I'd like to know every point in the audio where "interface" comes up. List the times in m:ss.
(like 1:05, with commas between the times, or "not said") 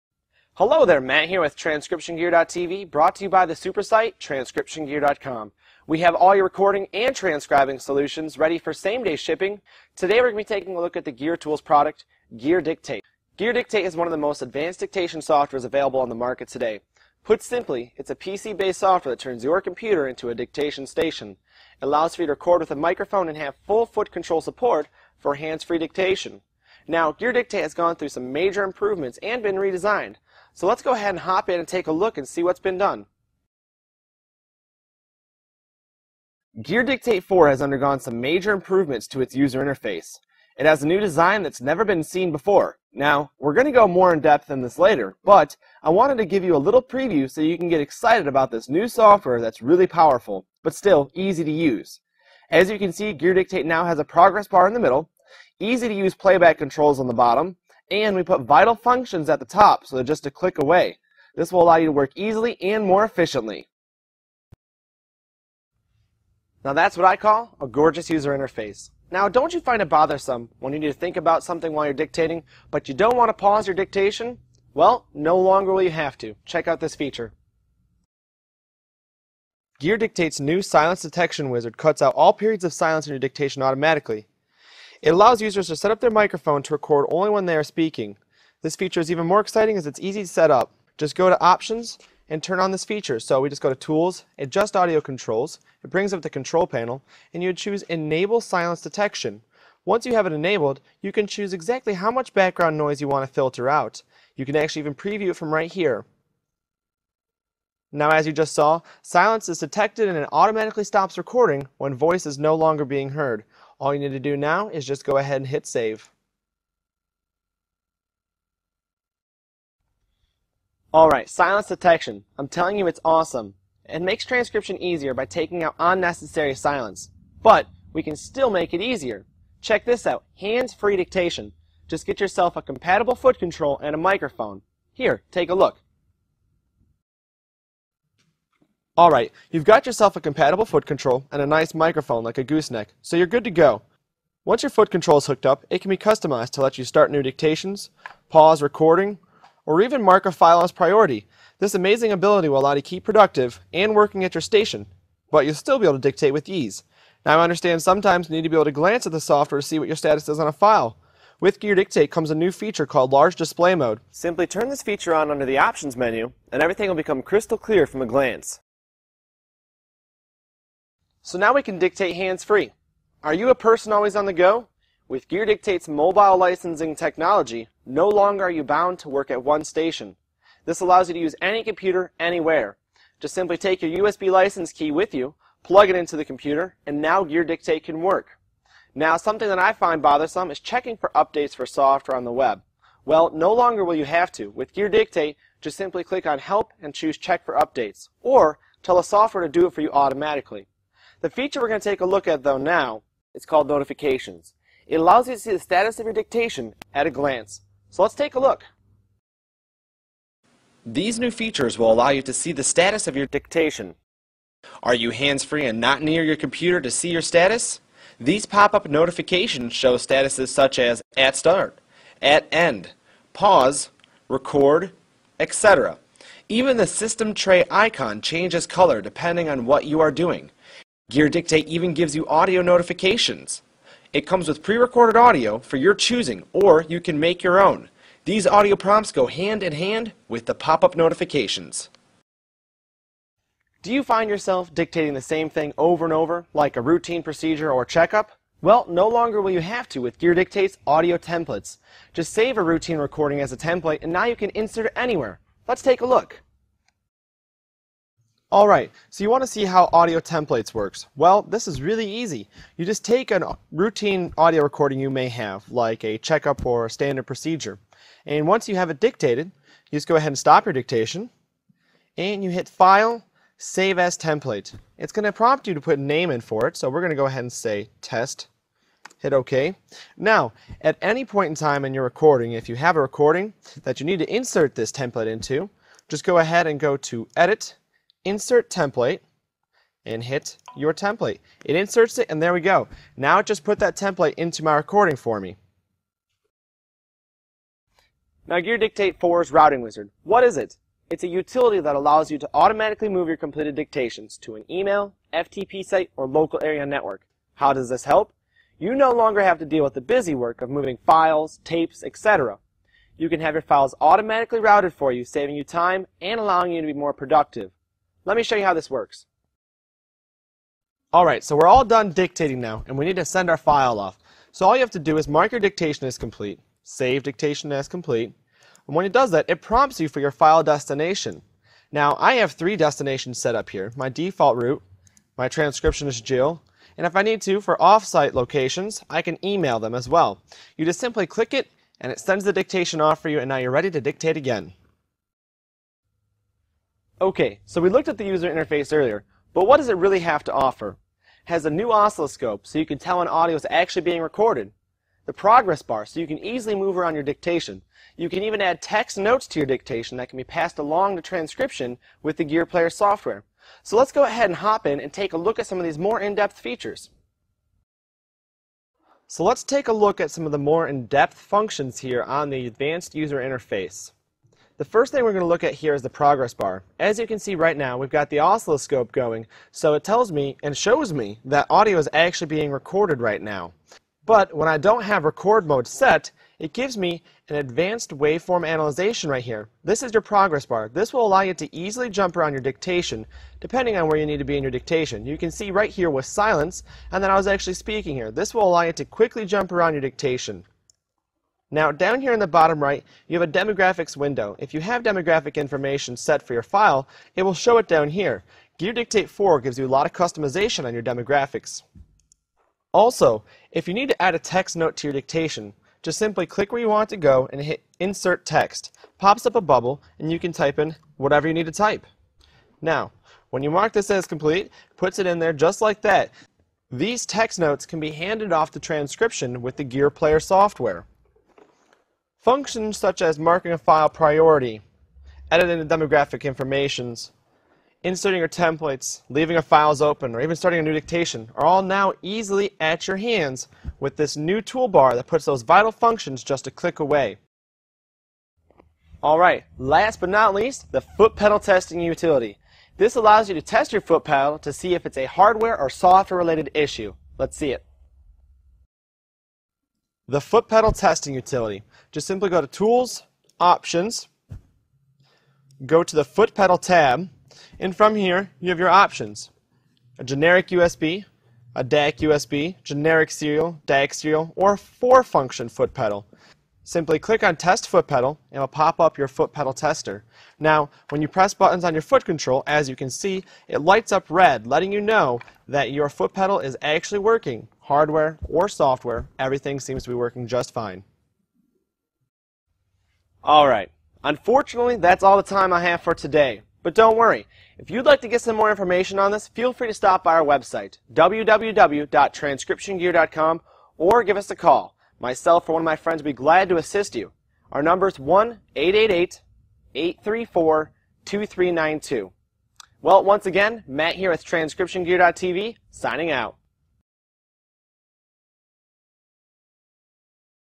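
0:39, 1:08, 5:48, 6:13.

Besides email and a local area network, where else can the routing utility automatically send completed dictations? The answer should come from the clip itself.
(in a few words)
FTP site.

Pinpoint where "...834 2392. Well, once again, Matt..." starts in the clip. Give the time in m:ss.
8:29.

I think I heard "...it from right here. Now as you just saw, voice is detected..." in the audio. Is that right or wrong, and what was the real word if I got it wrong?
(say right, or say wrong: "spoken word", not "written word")
wrong: "silence", not "voice".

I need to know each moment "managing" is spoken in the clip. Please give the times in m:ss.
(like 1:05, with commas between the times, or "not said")
not said.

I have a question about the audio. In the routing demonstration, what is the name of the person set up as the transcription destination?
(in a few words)
Jill.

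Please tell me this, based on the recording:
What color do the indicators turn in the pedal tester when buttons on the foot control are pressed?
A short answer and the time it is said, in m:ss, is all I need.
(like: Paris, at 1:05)
Red, at 8:04.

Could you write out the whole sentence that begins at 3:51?
Gear Dictate even gives you audio notifications.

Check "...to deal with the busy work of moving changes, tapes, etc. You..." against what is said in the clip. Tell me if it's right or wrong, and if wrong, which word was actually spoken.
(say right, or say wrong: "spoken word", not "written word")
wrong: "files", not "changes".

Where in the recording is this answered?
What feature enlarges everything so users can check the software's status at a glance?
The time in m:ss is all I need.
2:43.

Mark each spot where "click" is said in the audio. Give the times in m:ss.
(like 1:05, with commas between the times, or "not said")
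1:00, 3:16, 5:41, 6:56, 7:26, 7:57.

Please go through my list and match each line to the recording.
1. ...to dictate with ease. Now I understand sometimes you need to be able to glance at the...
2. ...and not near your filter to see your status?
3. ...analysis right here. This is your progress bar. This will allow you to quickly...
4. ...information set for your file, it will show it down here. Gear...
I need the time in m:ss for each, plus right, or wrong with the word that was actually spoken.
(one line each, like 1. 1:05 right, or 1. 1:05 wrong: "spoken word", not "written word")
1. 2:35 right
2. 3:35 wrong: "computer", not "filter"
3. 6:28 wrong: "easily", not "quickly"
4. 6:45 right.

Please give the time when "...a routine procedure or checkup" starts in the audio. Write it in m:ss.
4:06.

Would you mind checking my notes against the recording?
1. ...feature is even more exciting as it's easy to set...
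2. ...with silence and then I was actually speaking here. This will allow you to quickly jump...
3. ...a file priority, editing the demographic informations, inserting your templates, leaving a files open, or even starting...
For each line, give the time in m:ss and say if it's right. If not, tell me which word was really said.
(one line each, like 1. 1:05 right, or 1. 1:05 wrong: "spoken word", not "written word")
1. 1:28 right
2. 6:36 right
3. 7:13 right.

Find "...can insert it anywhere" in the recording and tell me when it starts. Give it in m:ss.
4:14.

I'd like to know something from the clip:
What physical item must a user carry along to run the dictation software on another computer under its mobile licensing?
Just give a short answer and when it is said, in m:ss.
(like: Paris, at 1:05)
USB license key, at 3:04.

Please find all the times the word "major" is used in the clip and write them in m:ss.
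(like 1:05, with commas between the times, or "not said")
0:28, 0:38.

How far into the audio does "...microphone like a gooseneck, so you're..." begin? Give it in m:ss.
2:21.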